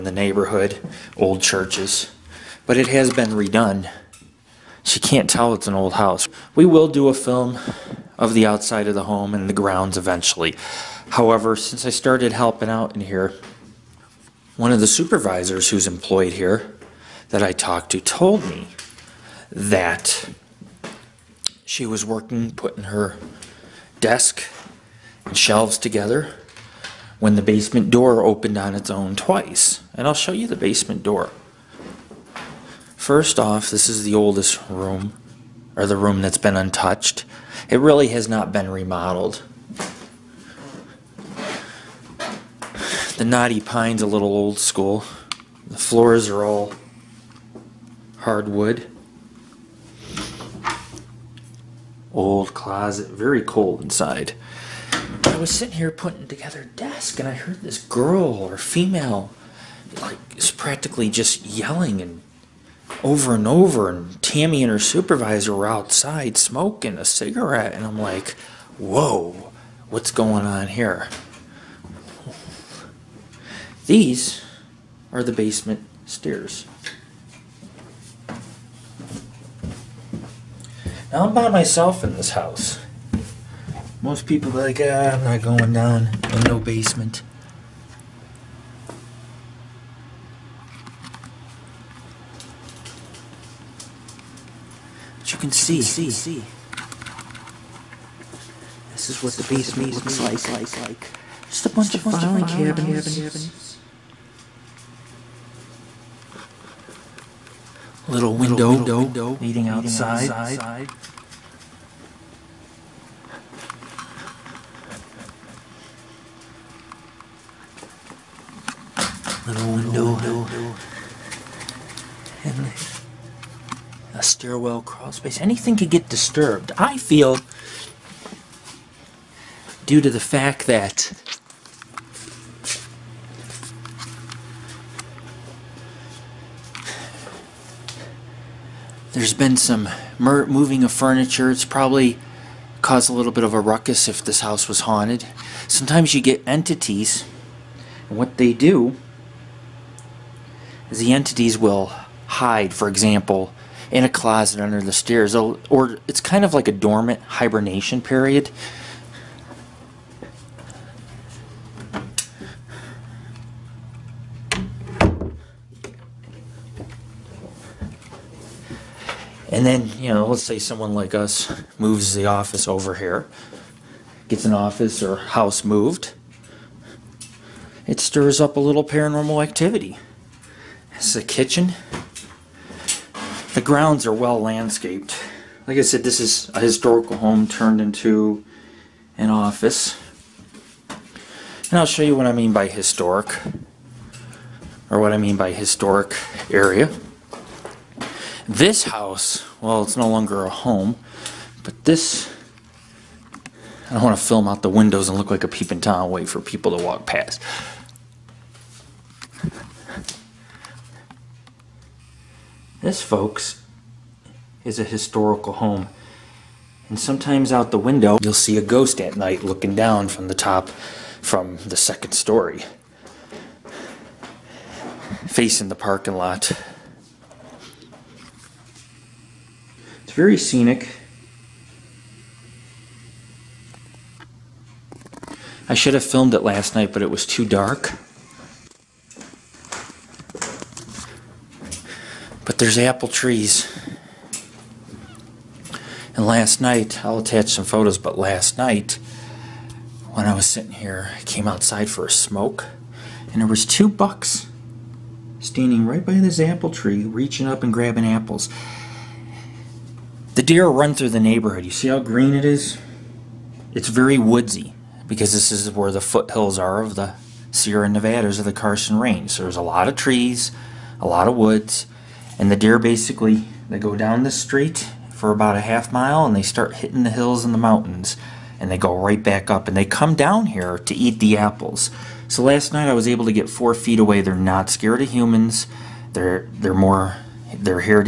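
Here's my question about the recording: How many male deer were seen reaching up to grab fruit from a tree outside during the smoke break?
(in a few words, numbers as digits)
2.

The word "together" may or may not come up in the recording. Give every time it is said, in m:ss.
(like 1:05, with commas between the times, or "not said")
0:25, 0:56.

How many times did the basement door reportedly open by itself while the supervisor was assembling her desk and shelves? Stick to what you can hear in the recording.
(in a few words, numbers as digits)
twice.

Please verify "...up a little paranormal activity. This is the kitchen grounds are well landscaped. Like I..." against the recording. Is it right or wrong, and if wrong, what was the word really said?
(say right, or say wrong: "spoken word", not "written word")
right.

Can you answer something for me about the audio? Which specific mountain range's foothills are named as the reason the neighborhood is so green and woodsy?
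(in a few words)
Carson Range.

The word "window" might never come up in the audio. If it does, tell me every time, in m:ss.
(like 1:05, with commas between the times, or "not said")
1:48, 3:24, 3:37.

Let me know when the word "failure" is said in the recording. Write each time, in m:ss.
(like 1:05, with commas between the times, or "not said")
not said.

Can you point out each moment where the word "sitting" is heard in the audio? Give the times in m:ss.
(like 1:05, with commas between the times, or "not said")
0:55, 4:10.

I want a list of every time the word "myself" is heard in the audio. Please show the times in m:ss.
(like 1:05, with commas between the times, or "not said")
1:21.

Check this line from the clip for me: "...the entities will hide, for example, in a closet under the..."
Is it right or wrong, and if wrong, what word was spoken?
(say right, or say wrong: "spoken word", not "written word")
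right.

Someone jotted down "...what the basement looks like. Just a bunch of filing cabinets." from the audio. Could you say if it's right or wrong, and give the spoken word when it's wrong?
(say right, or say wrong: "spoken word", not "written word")
right.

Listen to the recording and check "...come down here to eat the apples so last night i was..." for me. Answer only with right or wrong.
right.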